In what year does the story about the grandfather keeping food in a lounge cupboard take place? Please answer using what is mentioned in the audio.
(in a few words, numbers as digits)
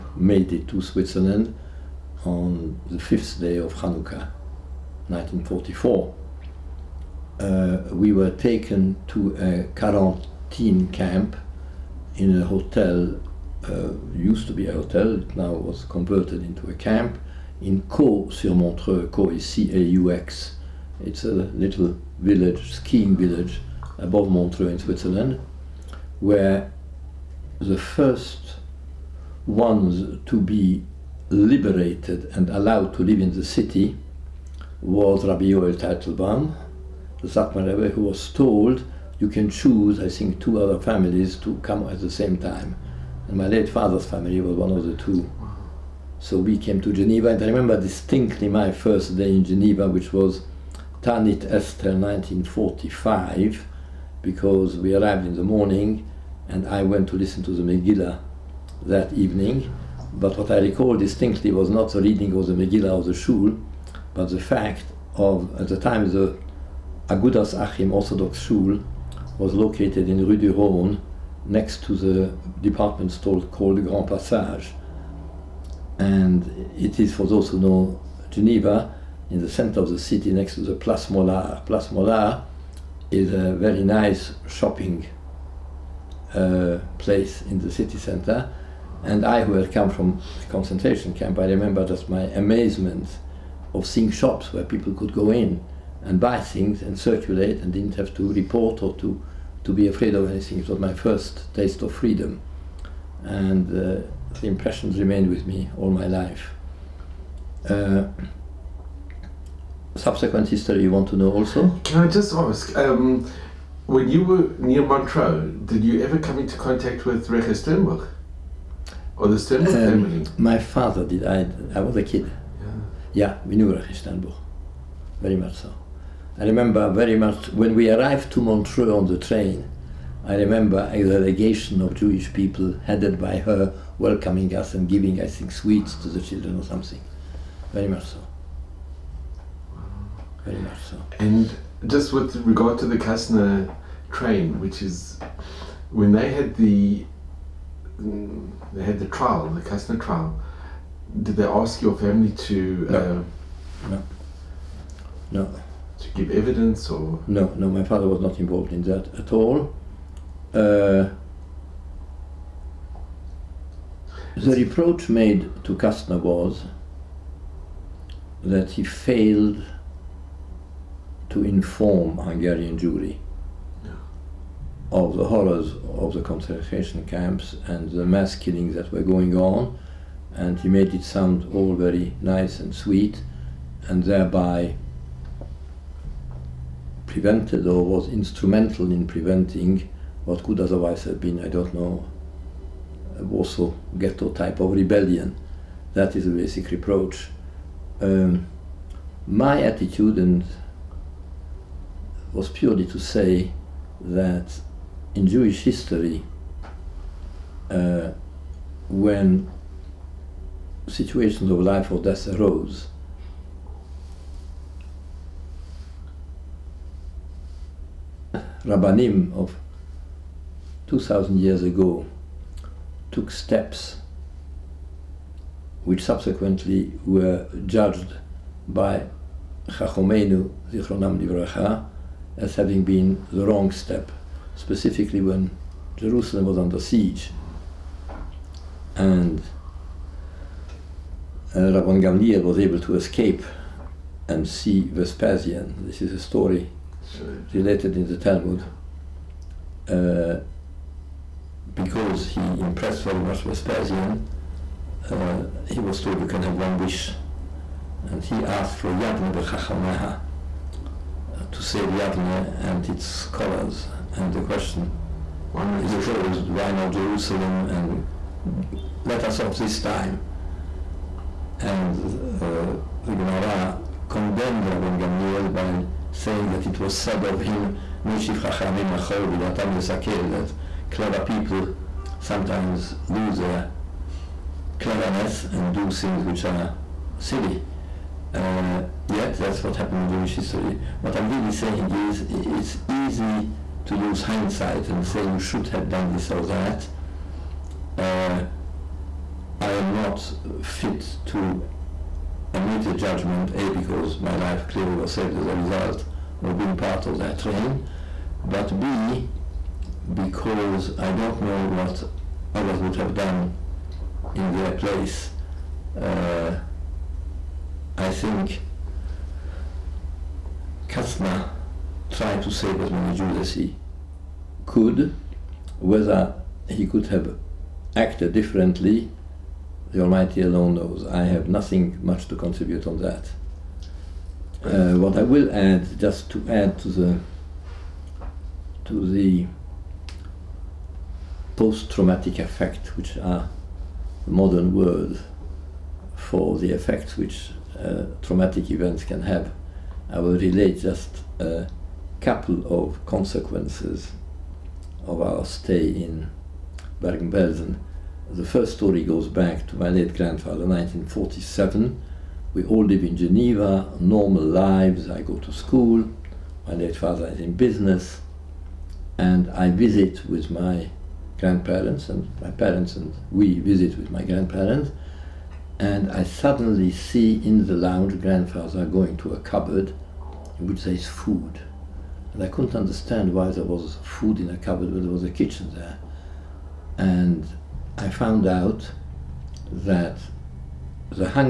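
1947.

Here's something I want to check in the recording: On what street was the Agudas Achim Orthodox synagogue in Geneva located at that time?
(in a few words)
Rue du Rhône.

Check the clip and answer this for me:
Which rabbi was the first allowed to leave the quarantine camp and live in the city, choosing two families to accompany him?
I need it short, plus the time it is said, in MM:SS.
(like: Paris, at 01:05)
Rabbi Yoel Teitelbaum, at 00:35.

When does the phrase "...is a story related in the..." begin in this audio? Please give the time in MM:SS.
04:06.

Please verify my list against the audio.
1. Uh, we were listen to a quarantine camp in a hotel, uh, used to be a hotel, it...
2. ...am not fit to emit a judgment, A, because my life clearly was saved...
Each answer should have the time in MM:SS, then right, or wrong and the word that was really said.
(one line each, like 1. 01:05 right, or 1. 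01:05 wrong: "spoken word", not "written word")
1. 00:07 wrong: "taken", not "listen"
2. 04:59 right.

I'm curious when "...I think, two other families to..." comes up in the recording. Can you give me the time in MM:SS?
00:39.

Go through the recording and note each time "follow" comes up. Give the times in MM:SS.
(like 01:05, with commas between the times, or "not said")
not said.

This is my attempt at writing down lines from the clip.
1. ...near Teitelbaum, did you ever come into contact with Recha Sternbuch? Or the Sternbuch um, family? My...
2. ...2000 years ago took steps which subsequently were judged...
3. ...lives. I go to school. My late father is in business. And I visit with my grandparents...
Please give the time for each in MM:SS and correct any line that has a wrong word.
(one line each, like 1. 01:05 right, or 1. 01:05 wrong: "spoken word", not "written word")
1. 01:54 wrong: "Montreux", not "Teitelbaum"
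2. 03:40 right
3. 06:04 right.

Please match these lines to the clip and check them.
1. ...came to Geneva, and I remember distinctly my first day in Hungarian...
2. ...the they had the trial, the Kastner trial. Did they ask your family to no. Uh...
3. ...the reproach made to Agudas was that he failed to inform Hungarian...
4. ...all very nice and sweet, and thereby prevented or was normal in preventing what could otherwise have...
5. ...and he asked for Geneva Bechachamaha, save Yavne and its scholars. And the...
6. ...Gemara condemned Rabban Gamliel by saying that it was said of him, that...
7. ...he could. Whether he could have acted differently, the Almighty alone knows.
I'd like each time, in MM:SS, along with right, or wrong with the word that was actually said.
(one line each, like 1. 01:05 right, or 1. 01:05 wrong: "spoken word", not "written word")
1. 00:46 wrong: "Geneva", not "Hungarian"
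2. 02:26 right
3. 02:44 wrong: "Kastner", not "Agudas"
4. 03:01 wrong: "instrumental", not "normal"
5. 04:18 wrong: "Yabne", not "Geneva"
6. 04:33 right
7. 05:23 right.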